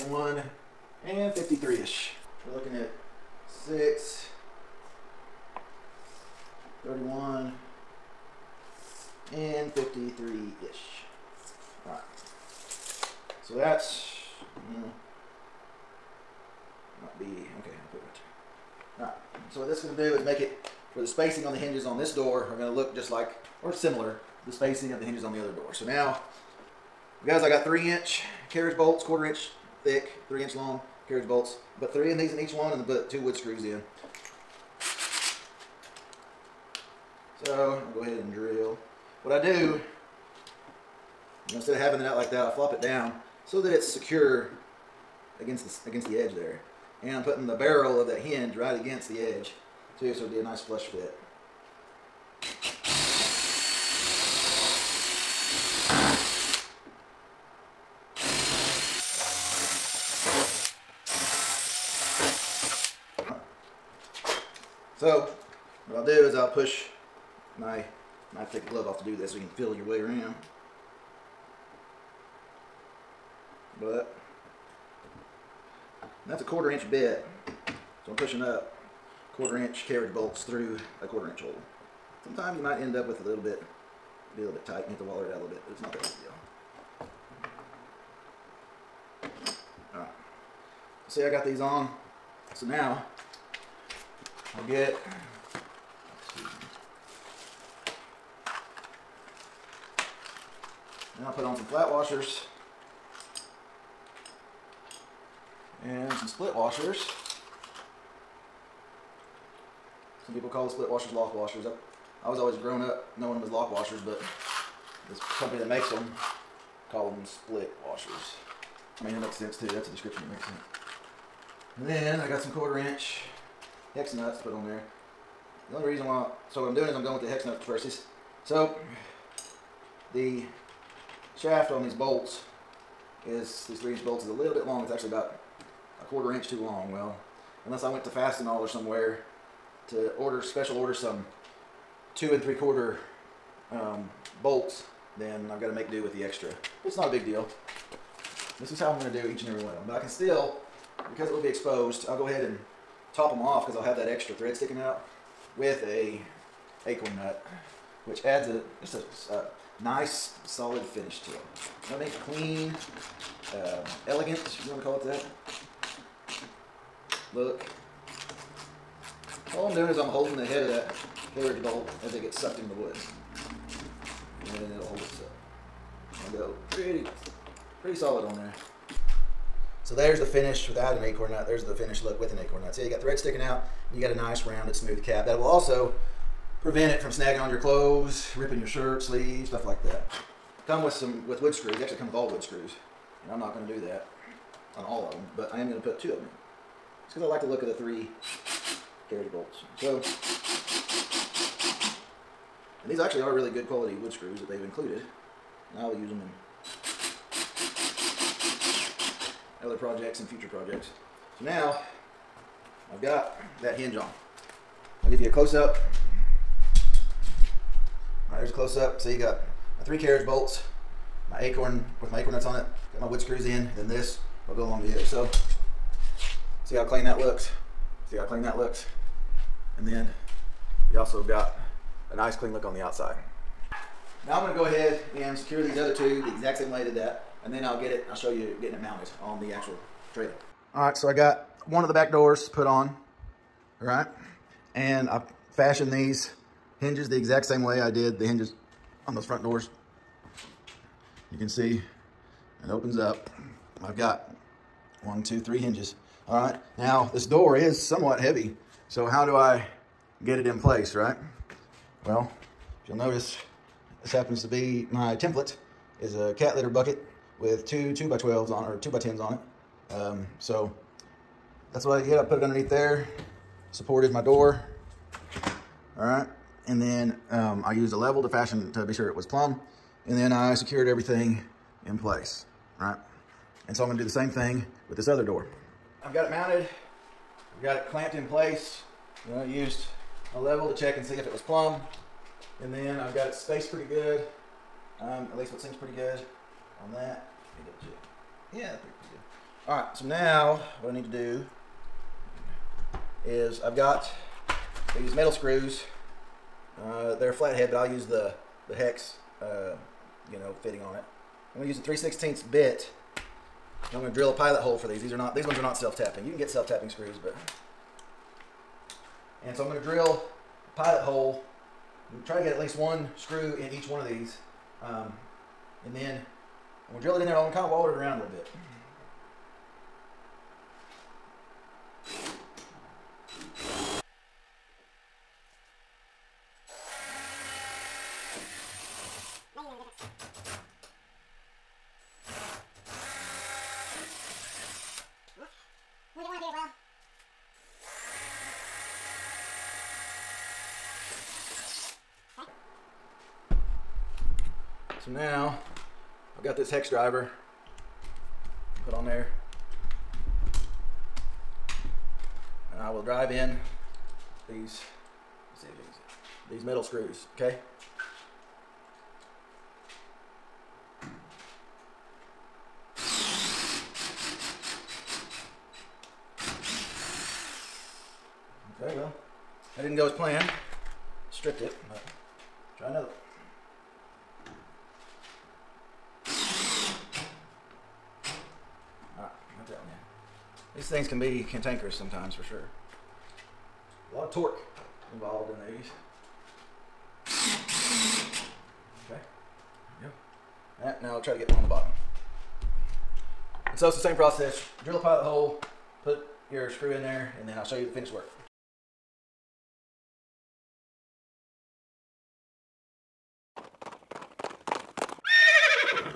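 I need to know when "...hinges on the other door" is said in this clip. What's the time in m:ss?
0:25.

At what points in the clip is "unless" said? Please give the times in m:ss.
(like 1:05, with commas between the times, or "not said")
2:17.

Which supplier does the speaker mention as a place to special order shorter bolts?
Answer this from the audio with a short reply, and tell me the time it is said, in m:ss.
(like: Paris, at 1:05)
Fastenal, at 2:18.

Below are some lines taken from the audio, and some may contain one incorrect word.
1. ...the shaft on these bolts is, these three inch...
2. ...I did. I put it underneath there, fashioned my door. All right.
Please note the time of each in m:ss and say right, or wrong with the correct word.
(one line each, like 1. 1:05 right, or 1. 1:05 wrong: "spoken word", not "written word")
1. 2:10 right
2. 4:31 wrong: "supported", not "fashioned".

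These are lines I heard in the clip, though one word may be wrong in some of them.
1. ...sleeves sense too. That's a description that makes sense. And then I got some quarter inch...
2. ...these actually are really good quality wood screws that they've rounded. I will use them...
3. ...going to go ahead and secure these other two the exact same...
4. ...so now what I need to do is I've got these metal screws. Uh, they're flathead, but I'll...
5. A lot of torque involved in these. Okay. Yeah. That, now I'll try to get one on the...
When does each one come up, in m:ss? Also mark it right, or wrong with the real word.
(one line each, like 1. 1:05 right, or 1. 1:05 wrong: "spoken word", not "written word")
1. 1:59 wrong: "makes", not "sleeves"
2. 3:22 wrong: "included", not "rounded"
3. 3:54 right
4. 4:59 right
5. 6:34 right.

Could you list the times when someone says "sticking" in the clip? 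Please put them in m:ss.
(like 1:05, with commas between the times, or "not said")
2:34, 3:03.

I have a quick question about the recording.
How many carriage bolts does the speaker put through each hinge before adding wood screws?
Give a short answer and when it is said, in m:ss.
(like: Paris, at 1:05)
3, at 0:31.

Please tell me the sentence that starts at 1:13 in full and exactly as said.
But that's a quarter inch bit.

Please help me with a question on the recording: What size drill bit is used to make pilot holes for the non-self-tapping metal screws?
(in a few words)
3/16.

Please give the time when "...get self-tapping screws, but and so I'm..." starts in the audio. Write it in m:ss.
5:16.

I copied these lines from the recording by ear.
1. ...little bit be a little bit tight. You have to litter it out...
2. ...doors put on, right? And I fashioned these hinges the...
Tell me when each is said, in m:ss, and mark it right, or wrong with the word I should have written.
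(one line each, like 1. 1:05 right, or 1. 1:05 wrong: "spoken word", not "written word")
1. 1:23 wrong: "waller", not "litter"
2. 4:02 right.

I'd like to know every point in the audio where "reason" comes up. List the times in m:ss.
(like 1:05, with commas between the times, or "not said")
2:05.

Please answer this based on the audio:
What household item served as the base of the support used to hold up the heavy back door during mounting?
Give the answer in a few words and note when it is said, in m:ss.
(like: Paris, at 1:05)
cat litter bucket, at 4:26.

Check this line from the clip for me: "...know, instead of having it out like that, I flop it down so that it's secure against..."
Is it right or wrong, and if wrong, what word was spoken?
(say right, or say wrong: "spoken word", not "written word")
right.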